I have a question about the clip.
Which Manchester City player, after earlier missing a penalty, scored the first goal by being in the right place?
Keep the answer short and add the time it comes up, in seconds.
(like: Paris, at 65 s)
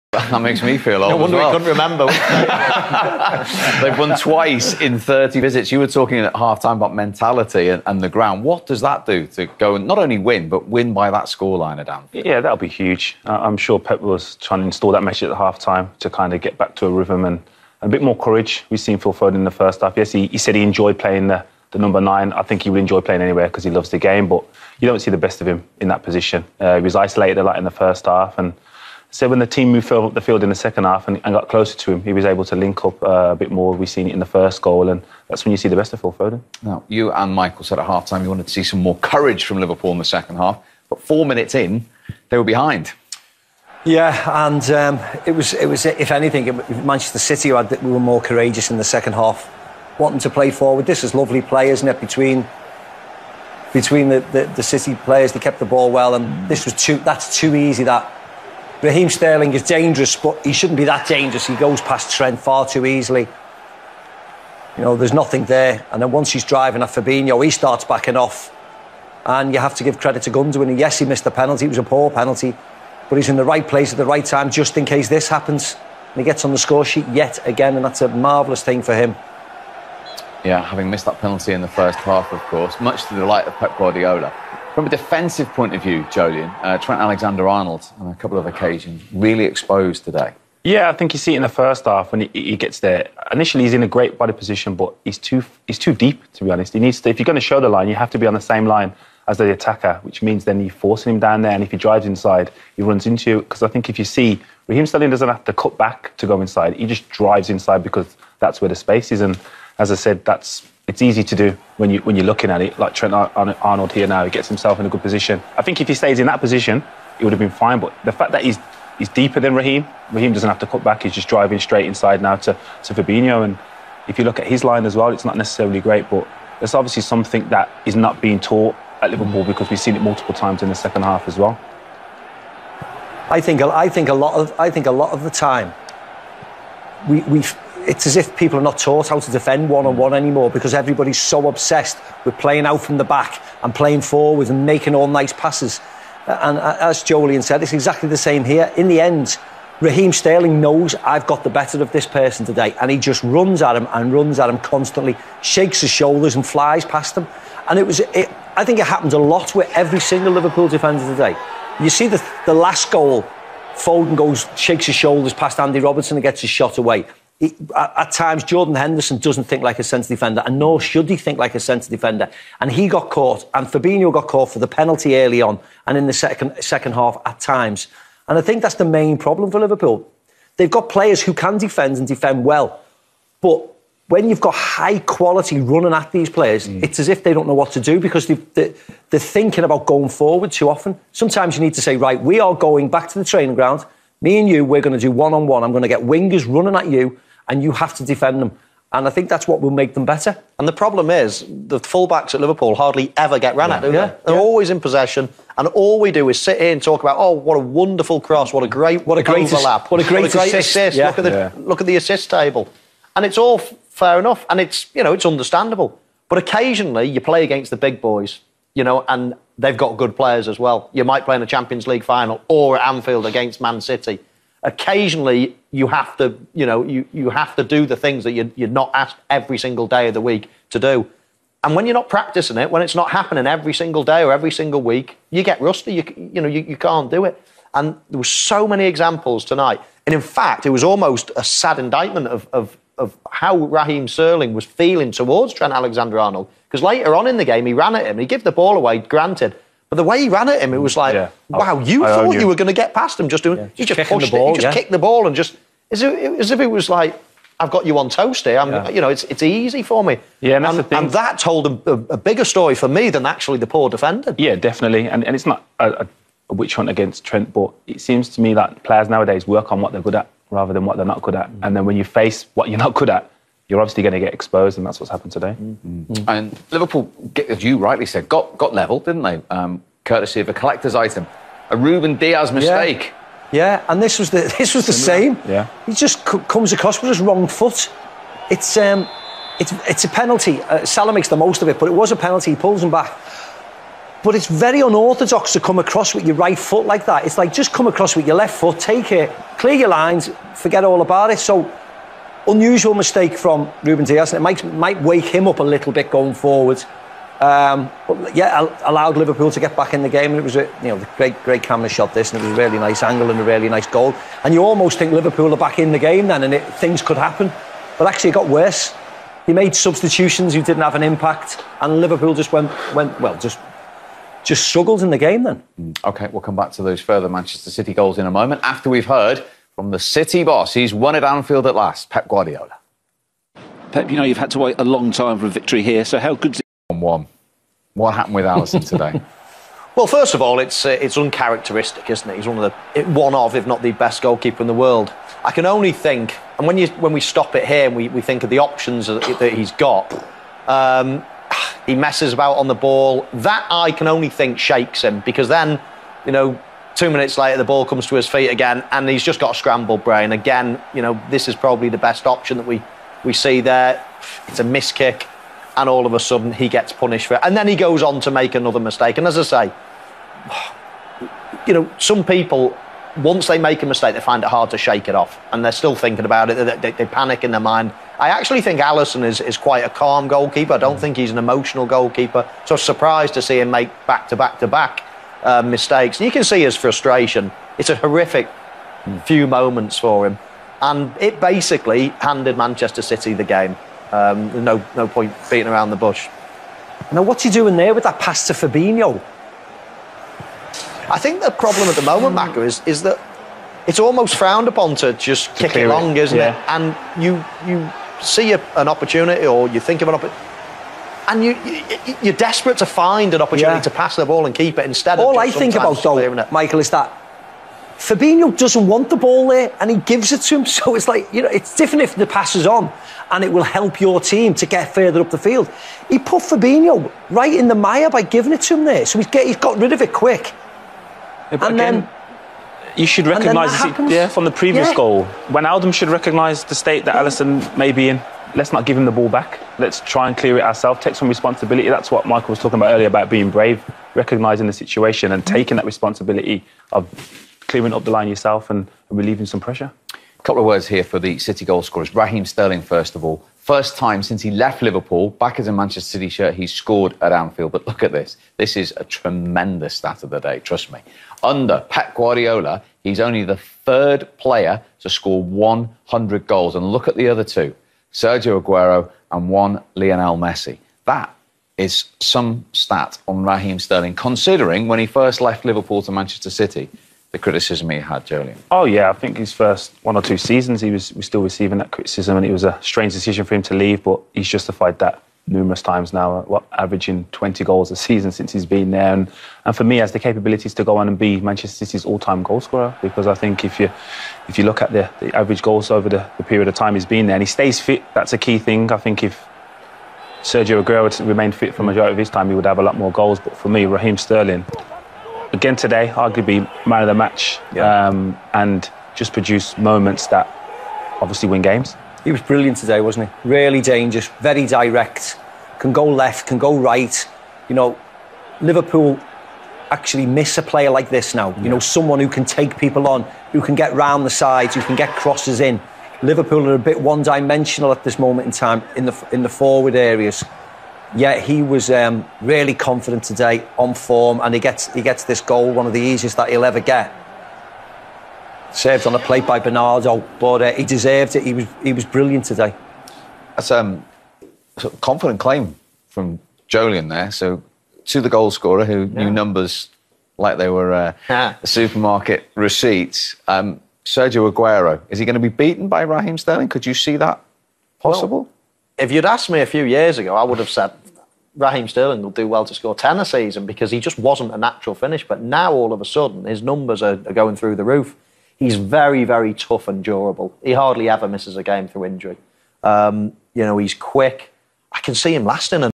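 Gundogan, at 70 s.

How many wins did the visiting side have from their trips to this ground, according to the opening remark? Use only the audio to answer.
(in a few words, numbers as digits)
2.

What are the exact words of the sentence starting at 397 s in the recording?
Now, what's he doing there with that pass to Fabinho?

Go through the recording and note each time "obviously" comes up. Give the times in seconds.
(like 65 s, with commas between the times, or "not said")
126 s, 273 s, 511 s.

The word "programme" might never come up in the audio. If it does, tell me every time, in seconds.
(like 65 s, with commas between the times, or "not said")
not said.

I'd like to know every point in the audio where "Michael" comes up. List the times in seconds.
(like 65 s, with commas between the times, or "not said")
37 s, 416 s, 442 s.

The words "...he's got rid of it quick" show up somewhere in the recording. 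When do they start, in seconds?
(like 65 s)
429 s.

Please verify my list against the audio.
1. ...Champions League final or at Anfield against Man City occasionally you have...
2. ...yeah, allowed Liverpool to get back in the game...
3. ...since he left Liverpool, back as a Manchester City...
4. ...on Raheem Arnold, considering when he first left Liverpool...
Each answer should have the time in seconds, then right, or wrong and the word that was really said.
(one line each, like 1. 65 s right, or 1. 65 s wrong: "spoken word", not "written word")
1. 221 s right
2. 308 s right
3. 454 s right
4. 473 s wrong: "Sterling", not "Arnold".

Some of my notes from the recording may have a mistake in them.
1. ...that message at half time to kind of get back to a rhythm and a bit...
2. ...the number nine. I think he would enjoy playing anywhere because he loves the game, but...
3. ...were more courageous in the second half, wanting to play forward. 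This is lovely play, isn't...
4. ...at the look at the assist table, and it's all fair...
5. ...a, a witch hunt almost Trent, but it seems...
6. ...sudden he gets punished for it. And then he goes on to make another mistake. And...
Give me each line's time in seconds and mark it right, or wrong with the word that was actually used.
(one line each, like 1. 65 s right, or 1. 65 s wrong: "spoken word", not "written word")
1. 14 s right
2. 21 s right
3. 47 s right
4. 211 s right
5. 265 s wrong: "against", not "almost"
6. 366 s right.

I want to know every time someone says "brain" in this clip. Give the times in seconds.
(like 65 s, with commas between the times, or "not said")
360 s.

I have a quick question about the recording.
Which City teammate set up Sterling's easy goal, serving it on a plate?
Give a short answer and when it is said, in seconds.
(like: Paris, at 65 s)
Bernardo, at 539 s.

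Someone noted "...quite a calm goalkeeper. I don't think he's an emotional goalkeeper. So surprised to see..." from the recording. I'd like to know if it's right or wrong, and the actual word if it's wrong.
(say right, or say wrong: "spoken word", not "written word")
right.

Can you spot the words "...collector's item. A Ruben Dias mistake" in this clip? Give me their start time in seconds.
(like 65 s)
280 s.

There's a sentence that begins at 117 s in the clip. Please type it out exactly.
But the fact that he's he's deeper than Raheem, Raheem doesn't have to cut back.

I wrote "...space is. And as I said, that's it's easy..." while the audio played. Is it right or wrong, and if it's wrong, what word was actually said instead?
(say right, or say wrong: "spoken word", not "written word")
right.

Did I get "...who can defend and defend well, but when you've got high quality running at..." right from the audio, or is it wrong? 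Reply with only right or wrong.
right.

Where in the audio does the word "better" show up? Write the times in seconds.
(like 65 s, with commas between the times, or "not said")
151 s, 200 s.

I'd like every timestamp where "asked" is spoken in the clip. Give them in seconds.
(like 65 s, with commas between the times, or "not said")
228 s, 559 s.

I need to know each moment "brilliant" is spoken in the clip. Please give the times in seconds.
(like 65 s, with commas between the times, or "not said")
512 s, 542 s.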